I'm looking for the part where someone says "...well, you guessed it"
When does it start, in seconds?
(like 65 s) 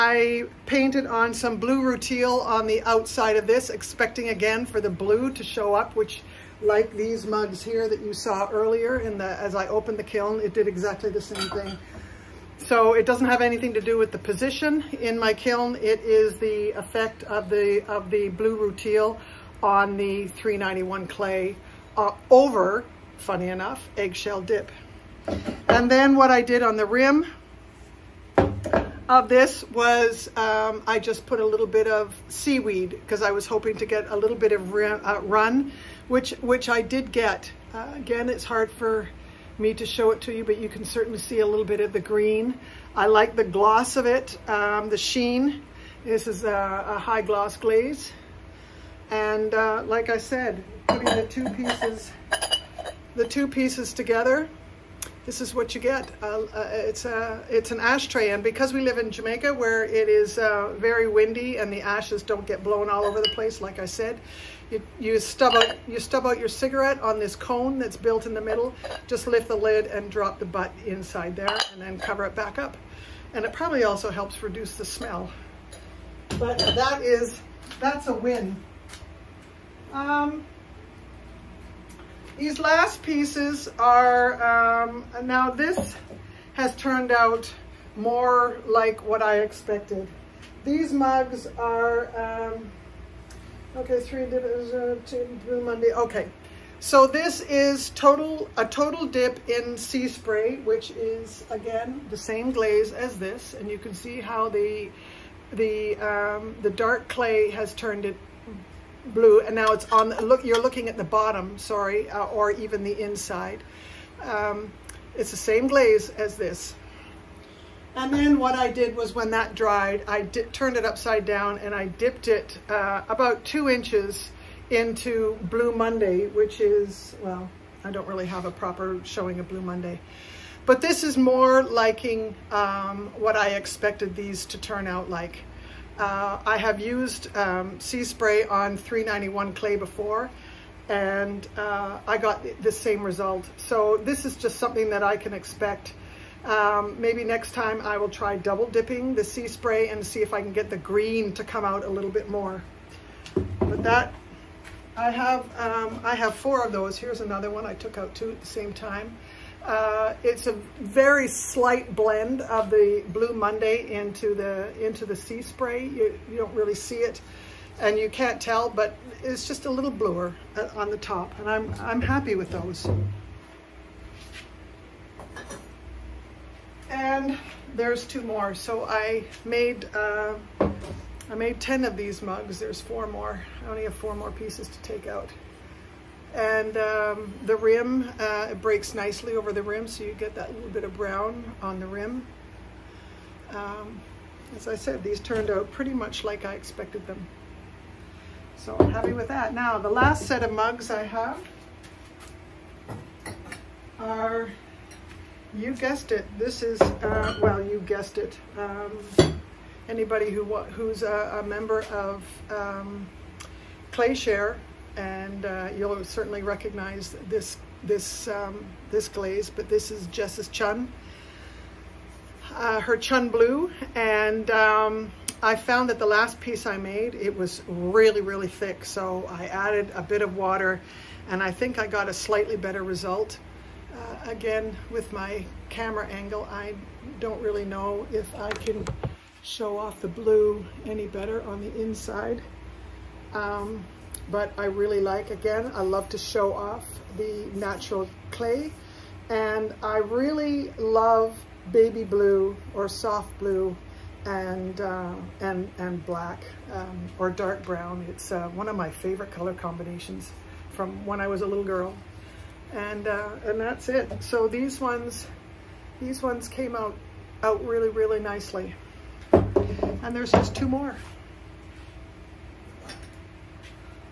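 207 s.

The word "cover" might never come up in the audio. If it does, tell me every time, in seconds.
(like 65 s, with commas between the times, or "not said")
71 s.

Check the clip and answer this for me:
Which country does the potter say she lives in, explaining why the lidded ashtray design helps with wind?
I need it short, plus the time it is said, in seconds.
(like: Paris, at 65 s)
Jamaica, at 59 s.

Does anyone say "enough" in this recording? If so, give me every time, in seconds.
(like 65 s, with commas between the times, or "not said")
23 s.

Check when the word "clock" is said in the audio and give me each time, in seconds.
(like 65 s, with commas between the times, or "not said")
not said.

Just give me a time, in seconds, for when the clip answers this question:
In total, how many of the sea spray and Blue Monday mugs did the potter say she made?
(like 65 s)
181 s.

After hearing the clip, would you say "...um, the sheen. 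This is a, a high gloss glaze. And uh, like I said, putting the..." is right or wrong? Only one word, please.
right.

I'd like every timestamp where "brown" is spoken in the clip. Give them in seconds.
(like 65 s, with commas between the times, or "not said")
190 s, 257 s.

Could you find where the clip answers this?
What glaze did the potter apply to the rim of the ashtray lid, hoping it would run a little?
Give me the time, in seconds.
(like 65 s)
32 s.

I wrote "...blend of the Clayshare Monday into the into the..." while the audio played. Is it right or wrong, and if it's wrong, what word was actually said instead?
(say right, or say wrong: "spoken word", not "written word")
wrong: "Blue", not "Clayshare".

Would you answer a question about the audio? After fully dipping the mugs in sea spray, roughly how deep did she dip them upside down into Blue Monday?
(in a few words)
2 inches.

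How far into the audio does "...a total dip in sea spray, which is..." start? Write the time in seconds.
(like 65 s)
98 s.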